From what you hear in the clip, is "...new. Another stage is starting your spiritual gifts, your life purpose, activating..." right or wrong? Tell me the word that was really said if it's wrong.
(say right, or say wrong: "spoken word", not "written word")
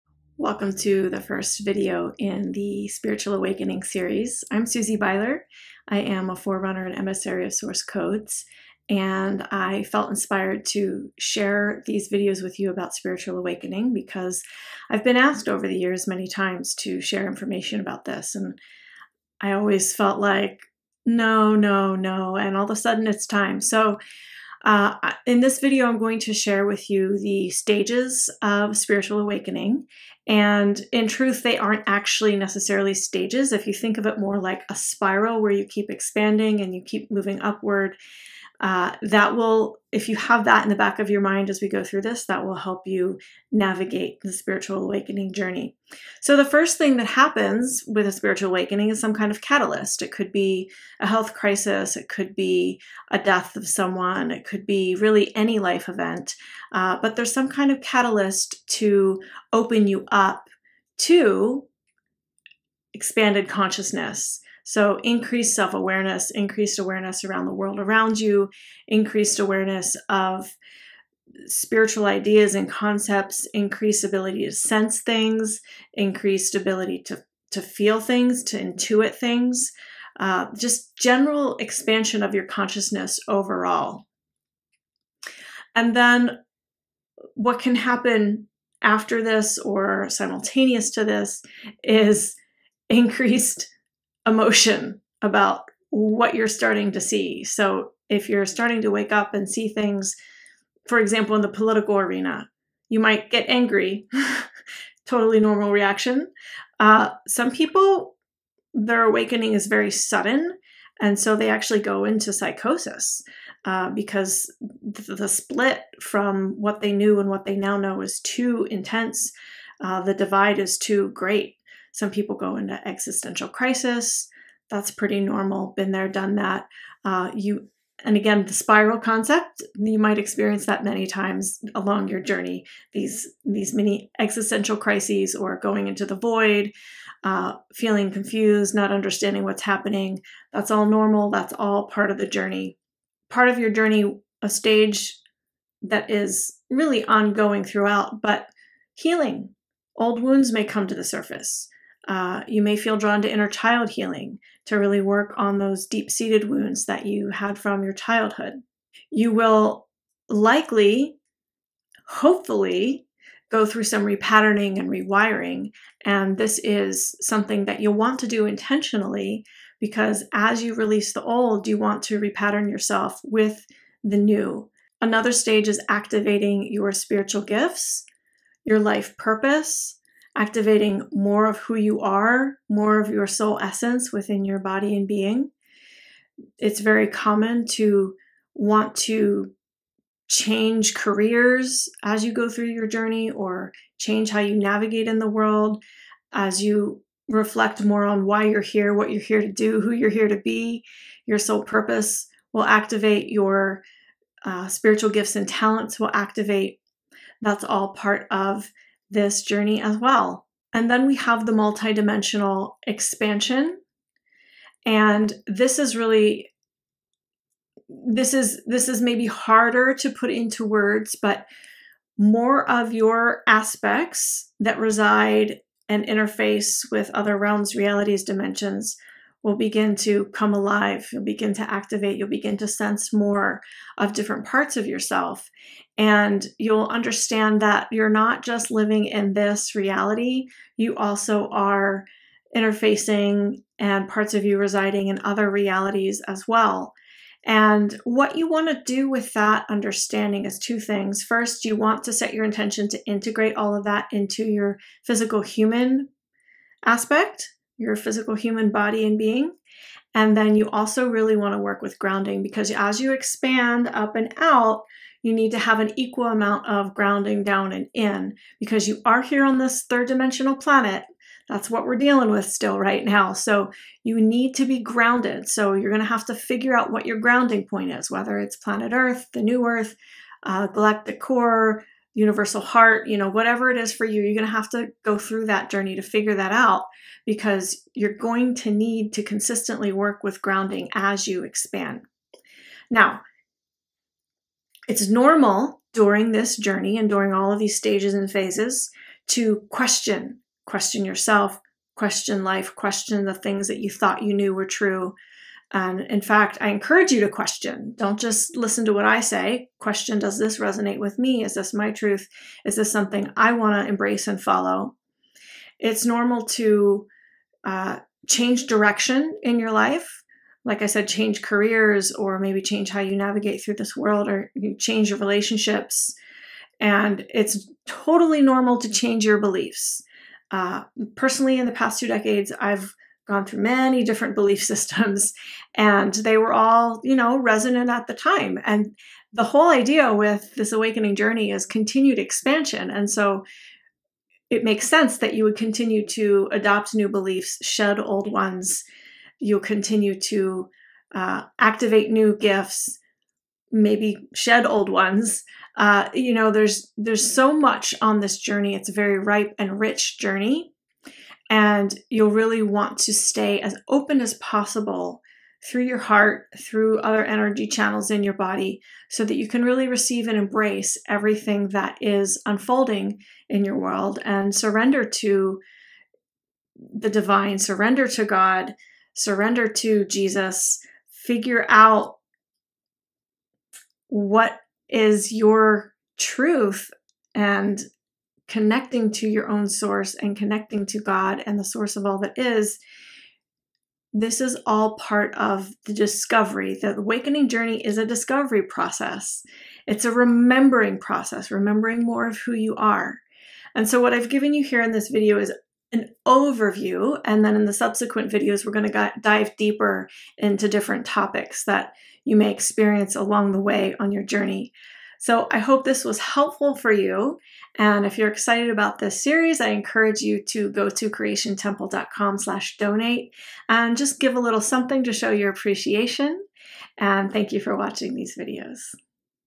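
wrong: "activating", not "starting".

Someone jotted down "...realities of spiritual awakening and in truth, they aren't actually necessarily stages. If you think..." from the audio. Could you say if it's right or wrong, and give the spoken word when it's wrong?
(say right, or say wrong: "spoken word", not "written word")
wrong: "stages", not "realities".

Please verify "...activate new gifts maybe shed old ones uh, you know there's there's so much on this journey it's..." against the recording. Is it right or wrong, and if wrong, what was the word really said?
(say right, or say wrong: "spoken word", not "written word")
right.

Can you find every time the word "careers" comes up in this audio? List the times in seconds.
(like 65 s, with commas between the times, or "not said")
190 s, 321 s.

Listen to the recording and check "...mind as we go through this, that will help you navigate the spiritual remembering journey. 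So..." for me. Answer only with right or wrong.
wrong.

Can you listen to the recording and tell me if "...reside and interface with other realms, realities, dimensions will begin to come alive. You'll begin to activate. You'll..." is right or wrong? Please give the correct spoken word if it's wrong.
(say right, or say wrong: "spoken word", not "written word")
right.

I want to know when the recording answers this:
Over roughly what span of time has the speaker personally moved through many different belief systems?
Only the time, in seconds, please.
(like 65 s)
332 s.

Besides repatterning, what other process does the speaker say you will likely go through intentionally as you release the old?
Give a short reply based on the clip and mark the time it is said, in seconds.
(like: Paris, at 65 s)
Rewiring, at 164 s.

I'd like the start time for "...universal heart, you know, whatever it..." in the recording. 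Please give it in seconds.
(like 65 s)
282 s.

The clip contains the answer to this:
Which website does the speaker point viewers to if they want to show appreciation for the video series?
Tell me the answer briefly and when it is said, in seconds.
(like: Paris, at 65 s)
creationtemple.com, at 421 s.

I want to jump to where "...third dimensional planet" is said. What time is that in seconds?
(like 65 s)
269 s.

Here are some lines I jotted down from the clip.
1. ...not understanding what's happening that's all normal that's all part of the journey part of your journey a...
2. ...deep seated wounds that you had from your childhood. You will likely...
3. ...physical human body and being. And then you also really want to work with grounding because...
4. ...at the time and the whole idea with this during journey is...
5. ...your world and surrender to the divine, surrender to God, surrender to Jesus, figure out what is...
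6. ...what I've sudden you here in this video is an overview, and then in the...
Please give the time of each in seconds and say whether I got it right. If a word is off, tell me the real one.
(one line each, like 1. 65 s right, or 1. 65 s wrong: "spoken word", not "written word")
1. 138 s right
2. 155 s right
3. 257 s right
4. 337 s wrong: "awakening", not "during"
5. 373 s right
6. 404 s wrong: "given", not "sudden".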